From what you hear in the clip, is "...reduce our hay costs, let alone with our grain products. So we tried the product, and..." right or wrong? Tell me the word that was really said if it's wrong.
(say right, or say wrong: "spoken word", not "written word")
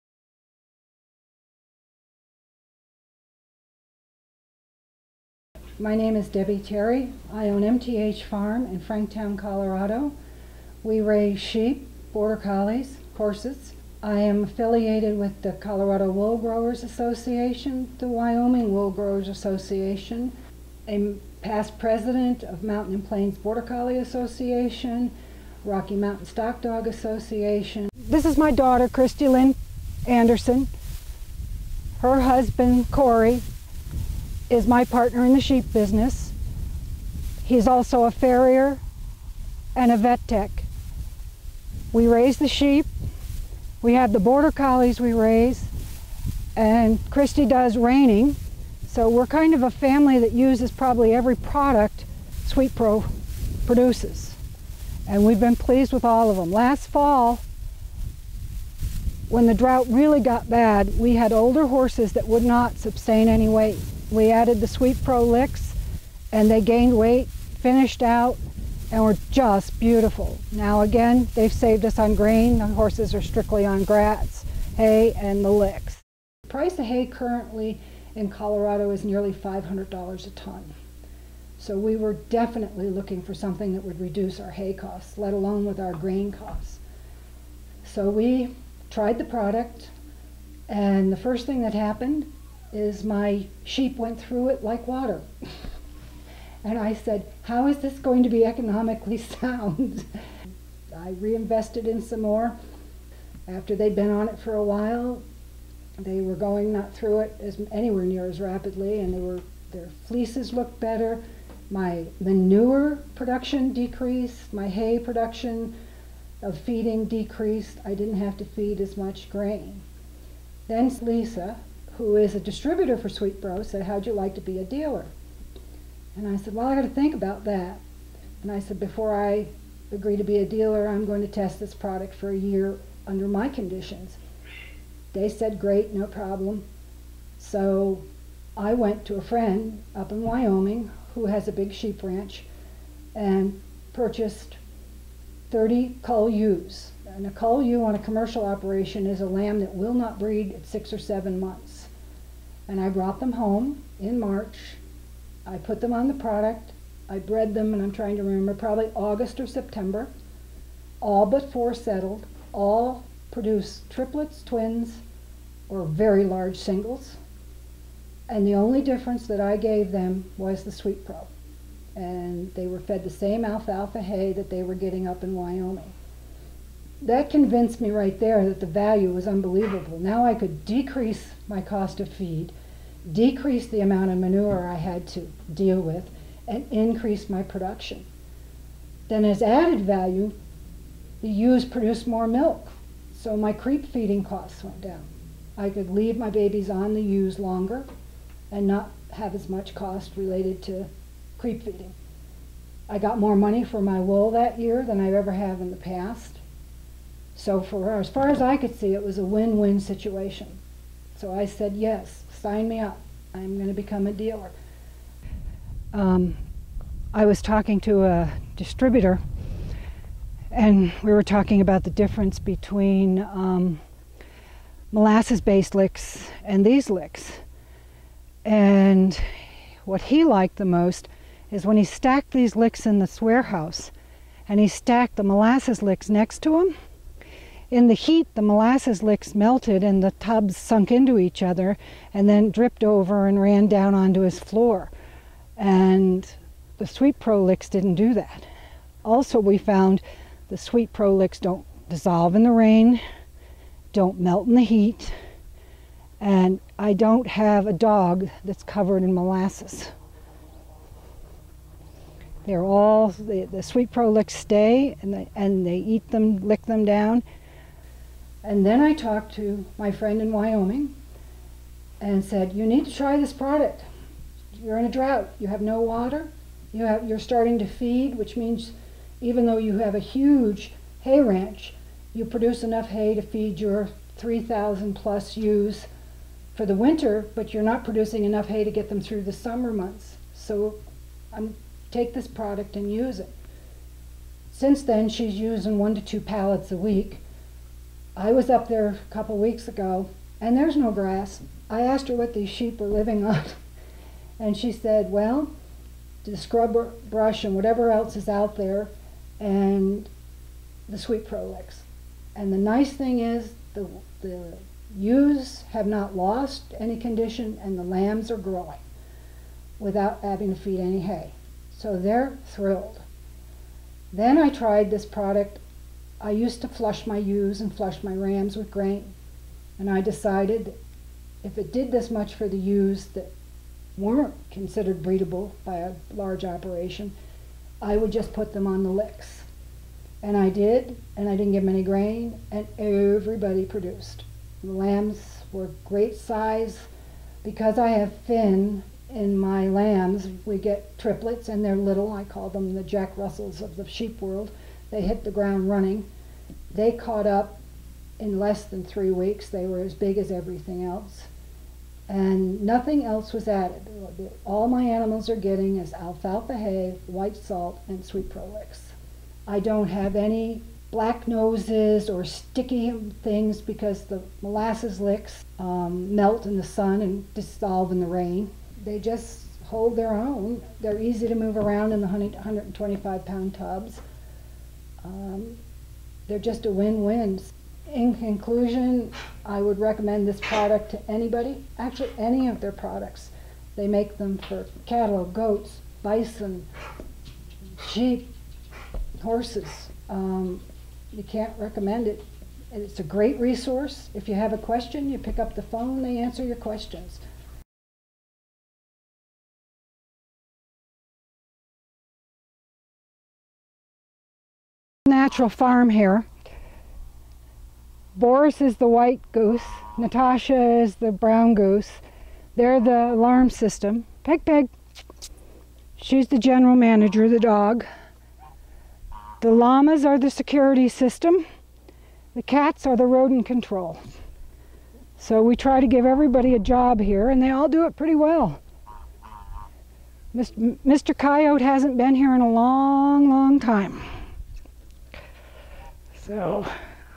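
wrong: "costs", not "products".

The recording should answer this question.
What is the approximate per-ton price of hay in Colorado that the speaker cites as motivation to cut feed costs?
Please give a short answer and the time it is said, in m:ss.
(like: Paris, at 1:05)
$500, at 1:19.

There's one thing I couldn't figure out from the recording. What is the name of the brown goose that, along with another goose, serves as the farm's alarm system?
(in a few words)
Natasha.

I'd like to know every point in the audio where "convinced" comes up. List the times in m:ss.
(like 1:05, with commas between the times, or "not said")
2:57.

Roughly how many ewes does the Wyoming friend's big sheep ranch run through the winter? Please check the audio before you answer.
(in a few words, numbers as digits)
3,000 plus.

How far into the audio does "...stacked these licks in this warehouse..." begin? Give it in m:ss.
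3:51.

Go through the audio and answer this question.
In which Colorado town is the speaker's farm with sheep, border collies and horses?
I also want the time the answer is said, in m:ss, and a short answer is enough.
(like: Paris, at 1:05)
Franktown, at 0:08.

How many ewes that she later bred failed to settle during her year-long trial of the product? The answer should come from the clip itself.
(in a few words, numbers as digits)
4.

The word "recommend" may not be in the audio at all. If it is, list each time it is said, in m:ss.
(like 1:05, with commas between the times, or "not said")
6:29, 6:41.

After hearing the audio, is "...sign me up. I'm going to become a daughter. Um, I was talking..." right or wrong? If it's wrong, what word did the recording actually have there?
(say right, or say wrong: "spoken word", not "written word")
wrong: "dealer", not "daughter".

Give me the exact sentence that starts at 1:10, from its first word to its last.
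Now again, they've saved us on grain.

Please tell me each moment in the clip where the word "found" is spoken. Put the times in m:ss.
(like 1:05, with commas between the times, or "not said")
4:09.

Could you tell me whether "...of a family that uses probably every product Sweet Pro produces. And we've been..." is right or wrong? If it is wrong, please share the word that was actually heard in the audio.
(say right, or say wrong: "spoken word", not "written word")
right.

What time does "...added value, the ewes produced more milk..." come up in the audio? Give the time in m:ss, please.
3:09.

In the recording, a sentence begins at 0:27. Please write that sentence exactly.
This is my daughter, Christy Lynn Anderson, her husband, Corey, is my partner in the sheep business.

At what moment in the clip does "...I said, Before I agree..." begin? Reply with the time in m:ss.
2:08.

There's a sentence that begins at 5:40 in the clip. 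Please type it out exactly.
And I did, and I didn't give them any grain, and everybody produced.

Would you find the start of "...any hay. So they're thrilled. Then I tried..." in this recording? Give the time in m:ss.
5:20.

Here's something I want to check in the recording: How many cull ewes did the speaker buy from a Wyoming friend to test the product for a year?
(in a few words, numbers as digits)
30.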